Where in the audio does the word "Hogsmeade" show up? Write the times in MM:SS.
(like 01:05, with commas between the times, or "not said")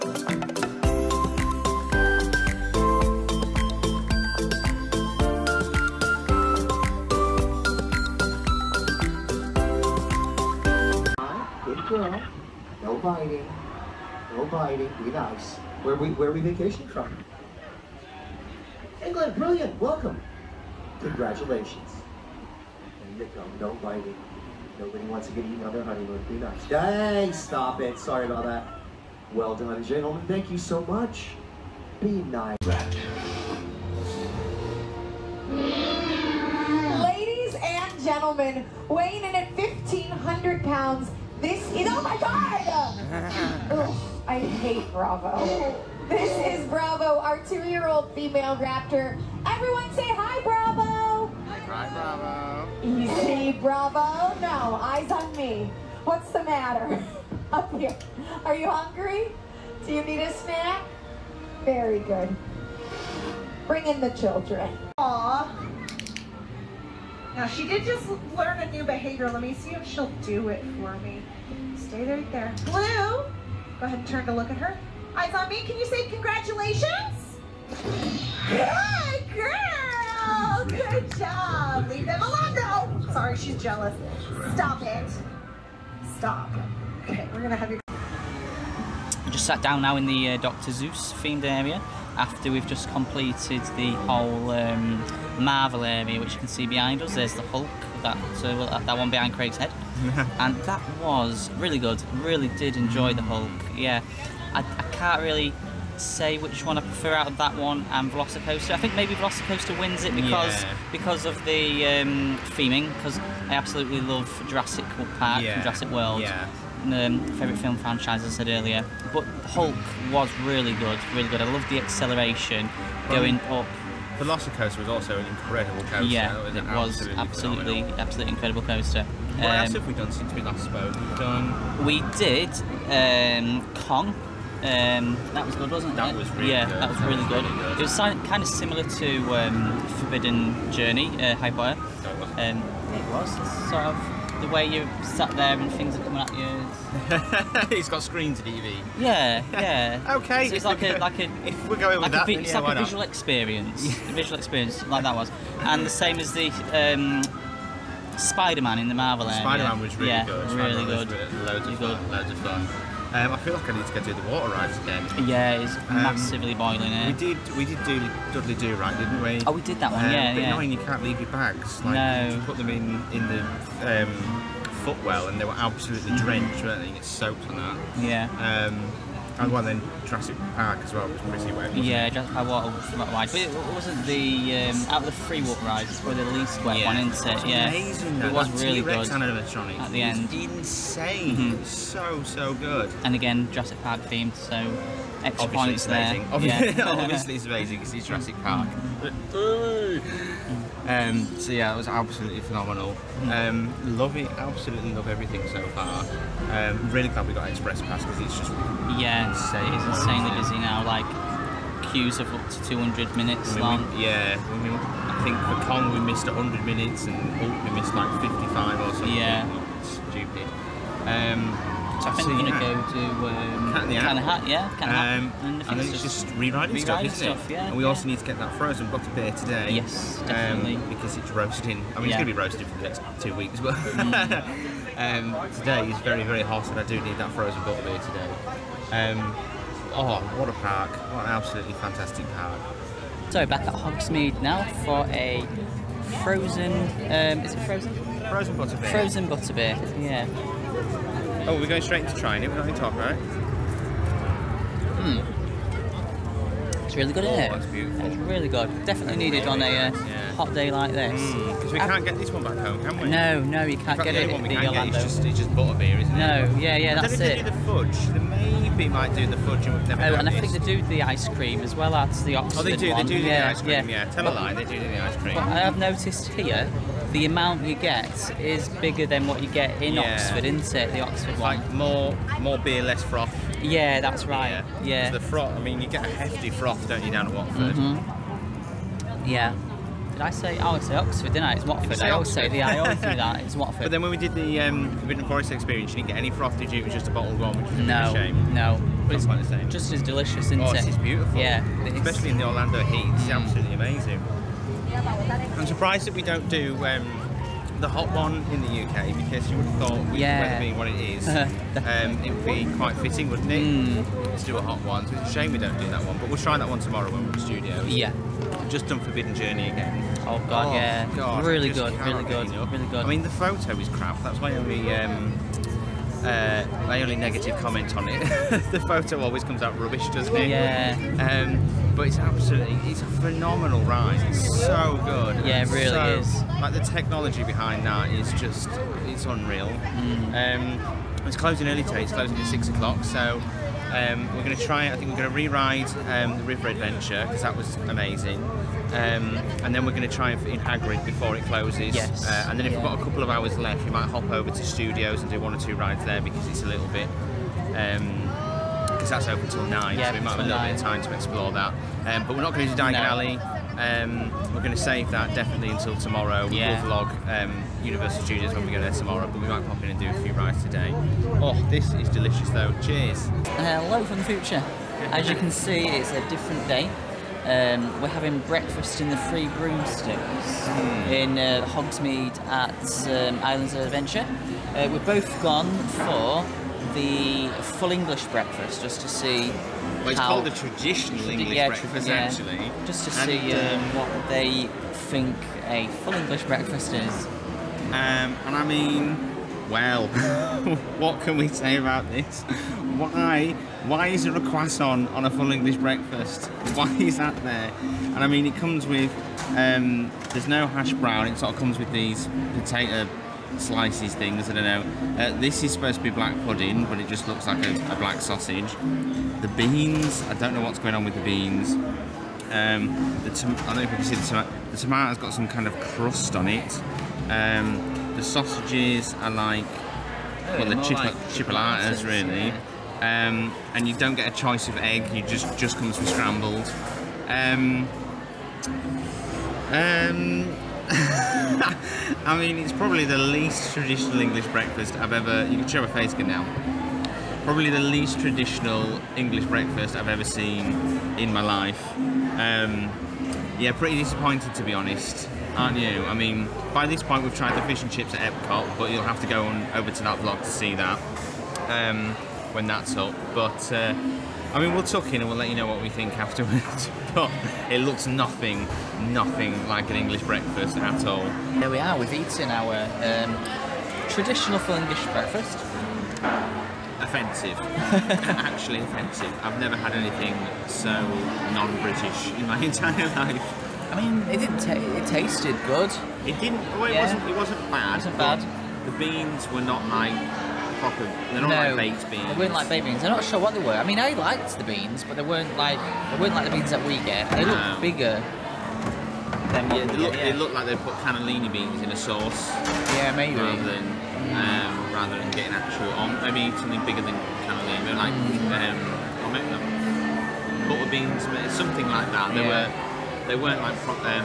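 04:03, 06:21.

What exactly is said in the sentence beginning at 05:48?
Um, and then we're going to try in Hagrid before it closes.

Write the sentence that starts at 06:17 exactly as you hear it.
Um, we're having breakfast in the Free Broomsticks mm.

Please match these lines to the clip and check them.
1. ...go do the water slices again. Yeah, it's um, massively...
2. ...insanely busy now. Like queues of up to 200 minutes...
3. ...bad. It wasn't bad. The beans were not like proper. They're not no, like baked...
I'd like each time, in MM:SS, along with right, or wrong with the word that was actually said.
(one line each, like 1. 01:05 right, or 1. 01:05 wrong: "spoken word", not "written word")
1. 02:43 wrong: "rides", not "slices"
2. 03:29 right
3. 08:07 right.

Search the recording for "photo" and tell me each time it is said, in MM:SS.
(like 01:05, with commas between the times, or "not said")
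05:23, 05:28.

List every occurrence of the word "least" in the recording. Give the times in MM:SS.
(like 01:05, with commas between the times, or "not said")
03:06, 07:23, 07:27.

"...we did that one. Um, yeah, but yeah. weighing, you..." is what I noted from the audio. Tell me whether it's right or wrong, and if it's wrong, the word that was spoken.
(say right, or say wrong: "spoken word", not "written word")
wrong: "annoying", not "weighing".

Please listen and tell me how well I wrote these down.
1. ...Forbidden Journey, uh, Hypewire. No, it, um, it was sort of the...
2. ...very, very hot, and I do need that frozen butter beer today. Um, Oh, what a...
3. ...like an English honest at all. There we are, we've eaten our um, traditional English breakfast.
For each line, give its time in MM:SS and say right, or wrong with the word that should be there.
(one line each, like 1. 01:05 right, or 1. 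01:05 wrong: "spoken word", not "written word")
1. 02:19 right
2. 03:55 right
3. 07:49 wrong: "breakfast", not "honest".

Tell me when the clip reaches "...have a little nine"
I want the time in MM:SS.
06:00.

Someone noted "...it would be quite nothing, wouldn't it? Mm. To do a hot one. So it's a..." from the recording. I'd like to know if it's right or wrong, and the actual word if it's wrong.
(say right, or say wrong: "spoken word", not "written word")
wrong: "fitting", not "nothing".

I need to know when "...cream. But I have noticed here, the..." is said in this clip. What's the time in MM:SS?
04:35.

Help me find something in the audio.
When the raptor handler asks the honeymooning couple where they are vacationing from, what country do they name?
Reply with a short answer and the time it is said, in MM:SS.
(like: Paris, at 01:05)
England, at 00:19.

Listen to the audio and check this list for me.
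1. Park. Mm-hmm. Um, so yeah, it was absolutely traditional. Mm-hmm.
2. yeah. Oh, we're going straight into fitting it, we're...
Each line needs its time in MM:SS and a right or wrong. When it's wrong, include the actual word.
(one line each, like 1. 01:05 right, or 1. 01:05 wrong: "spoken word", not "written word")
1. 03:18 wrong: "phenomenal", not "traditional"
2. 04:10 wrong: "trying", not "fitting".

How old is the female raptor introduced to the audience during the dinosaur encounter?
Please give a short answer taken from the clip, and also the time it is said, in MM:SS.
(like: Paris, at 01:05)
2 years old, at 00:47.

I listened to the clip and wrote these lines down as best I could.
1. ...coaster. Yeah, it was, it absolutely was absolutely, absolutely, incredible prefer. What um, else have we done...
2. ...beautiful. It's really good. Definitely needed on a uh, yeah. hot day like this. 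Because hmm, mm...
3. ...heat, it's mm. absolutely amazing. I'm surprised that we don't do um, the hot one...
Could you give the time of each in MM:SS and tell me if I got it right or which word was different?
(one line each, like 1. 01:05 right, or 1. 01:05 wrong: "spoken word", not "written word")
1. 02:05 wrong: "coaster", not "prefer"
2. 04:17 right
3. 05:02 right.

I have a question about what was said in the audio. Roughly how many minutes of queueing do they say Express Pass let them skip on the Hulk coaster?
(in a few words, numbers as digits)
55 minutes.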